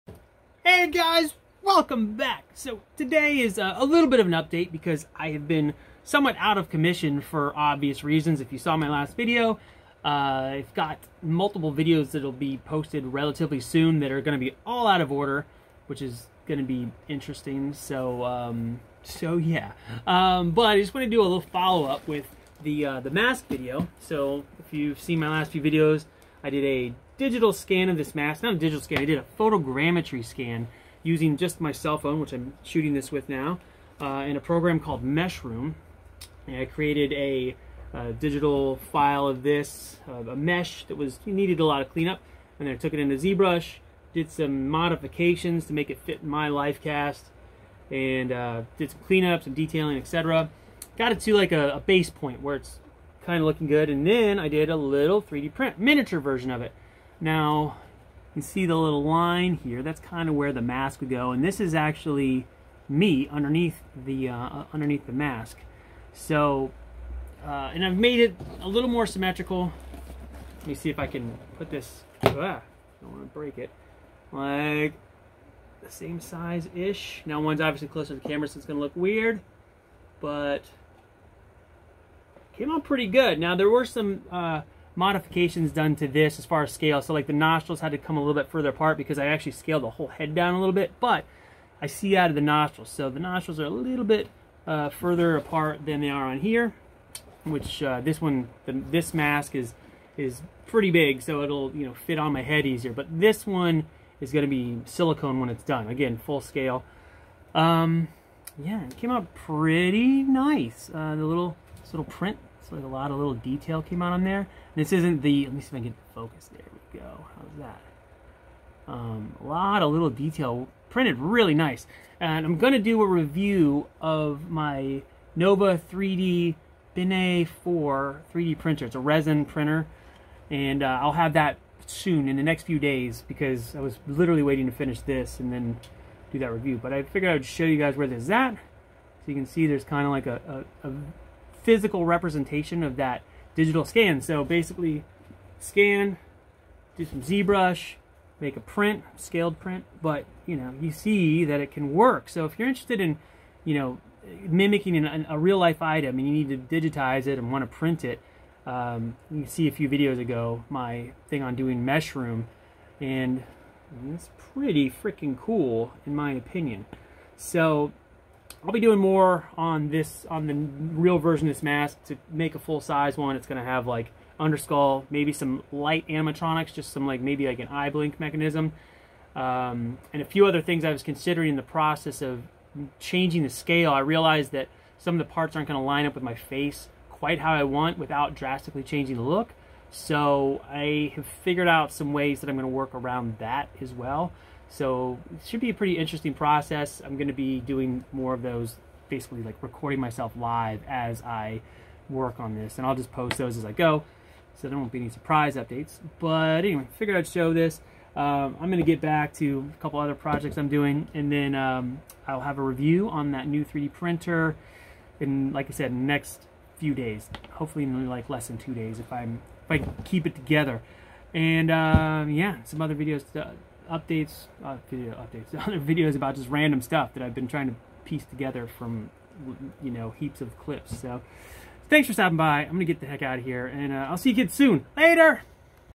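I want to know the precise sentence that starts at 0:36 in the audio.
And I created a, a digital file of this, uh, a mesh that was needed a lot of cleanup.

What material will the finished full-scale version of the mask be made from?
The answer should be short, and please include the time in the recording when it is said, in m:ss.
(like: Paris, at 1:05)
silicone, at 1:44.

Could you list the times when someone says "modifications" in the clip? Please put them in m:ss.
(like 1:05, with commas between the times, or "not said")
0:44, 1:24.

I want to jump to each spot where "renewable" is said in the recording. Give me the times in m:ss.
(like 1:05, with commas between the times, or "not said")
not said.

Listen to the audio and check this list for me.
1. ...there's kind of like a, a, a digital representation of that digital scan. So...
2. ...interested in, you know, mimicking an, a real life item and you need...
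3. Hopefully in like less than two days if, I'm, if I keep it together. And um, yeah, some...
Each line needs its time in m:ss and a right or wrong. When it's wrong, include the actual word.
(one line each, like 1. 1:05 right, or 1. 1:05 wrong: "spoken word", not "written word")
1. 2:19 wrong: "physical", not "digital"
2. 2:32 right
3. 3:37 right.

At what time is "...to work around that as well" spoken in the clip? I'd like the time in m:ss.
3:12.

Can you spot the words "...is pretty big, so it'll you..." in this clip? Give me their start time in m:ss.
1:40.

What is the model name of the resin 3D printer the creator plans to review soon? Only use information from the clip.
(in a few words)
Nova 3D Bene 4.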